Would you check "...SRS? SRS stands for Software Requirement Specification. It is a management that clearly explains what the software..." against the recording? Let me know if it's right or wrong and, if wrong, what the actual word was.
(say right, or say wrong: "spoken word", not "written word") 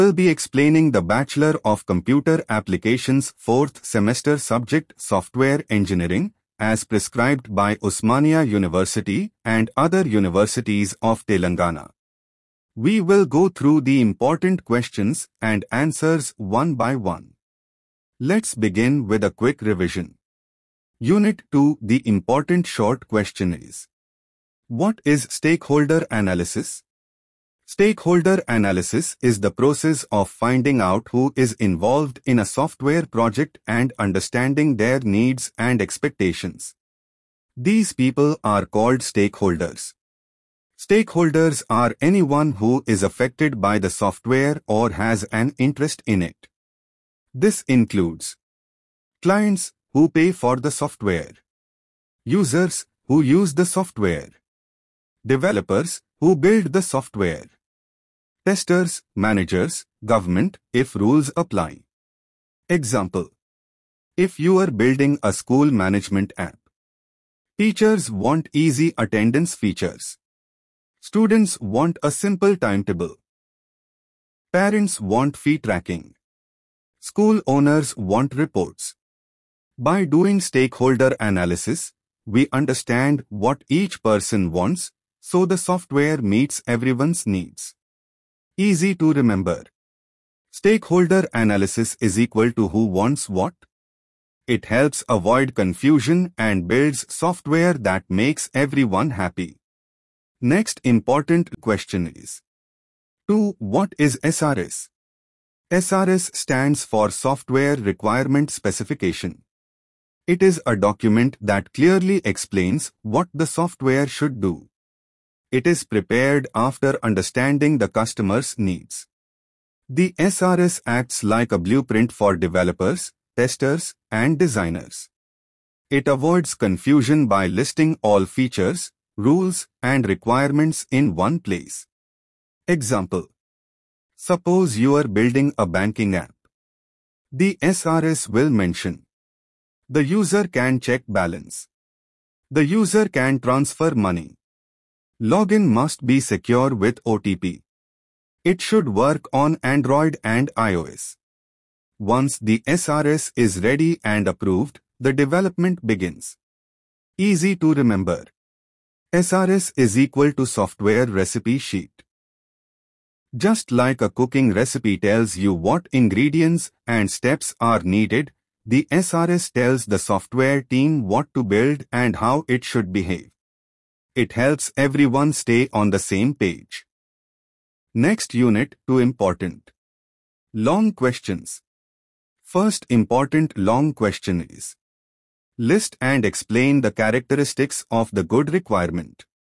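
wrong: "document", not "management".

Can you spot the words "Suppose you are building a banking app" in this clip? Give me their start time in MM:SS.
02:14.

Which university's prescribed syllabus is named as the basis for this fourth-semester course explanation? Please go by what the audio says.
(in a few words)
Osmania University.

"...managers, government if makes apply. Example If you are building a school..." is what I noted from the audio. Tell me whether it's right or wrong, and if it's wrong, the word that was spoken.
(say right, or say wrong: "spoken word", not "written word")
wrong: "rules", not "makes".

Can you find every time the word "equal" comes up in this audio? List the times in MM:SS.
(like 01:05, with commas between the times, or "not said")
01:32, 02:39.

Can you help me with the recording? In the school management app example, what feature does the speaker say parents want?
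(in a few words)
Fee tracking.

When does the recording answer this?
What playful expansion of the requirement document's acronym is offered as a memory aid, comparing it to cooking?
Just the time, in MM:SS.
02:40.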